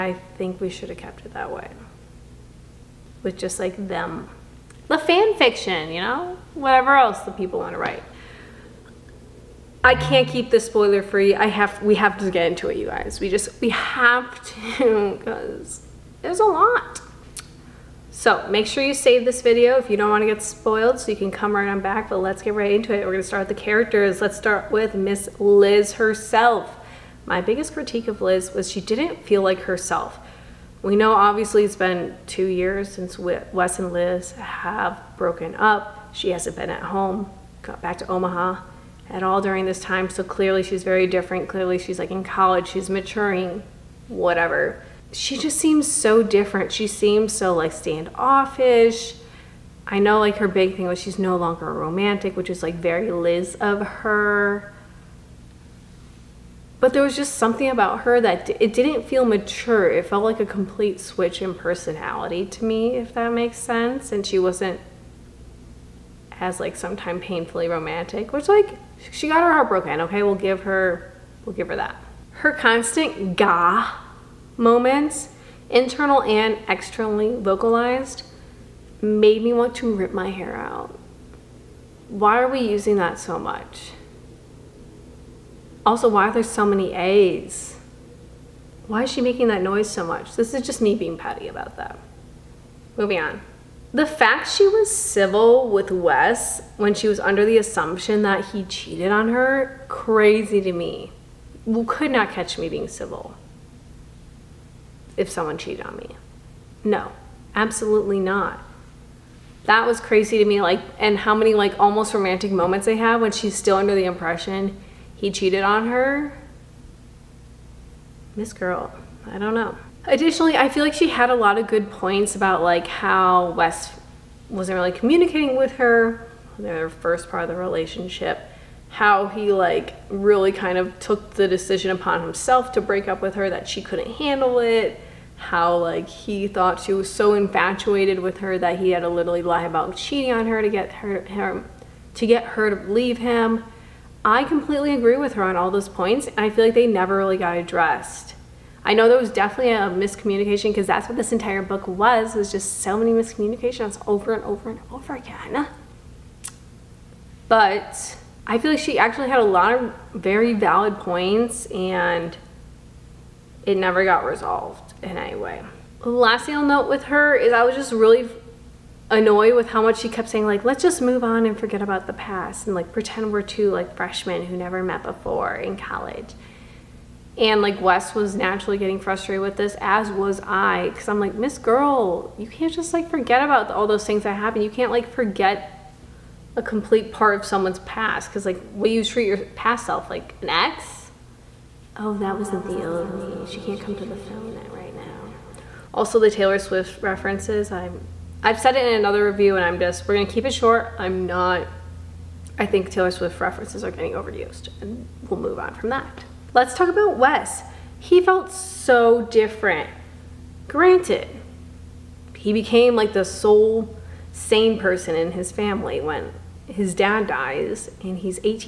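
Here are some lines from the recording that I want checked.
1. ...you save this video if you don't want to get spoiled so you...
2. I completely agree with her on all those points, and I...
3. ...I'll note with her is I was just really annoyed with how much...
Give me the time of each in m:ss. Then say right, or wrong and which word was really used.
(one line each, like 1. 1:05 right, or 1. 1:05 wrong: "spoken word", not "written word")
1. 0:18 right
2. 2:24 right
3. 2:46 right.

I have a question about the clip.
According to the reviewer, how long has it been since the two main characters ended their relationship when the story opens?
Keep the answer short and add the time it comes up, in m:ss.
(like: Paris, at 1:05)
2 years, at 0:32.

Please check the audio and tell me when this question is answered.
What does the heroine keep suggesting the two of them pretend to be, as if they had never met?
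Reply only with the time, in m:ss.
2:53.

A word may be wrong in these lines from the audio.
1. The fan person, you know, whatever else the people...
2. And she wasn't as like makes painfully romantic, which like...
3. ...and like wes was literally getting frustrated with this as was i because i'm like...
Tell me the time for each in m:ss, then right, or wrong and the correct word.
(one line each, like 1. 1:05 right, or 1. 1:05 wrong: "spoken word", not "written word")
1. 0:04 wrong: "fiction", not "person"
2. 1:04 wrong: "sometimes", not "makes"
3. 2:57 wrong: "naturally", not "literally".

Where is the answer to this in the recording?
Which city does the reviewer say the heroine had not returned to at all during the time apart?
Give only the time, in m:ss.
0:38.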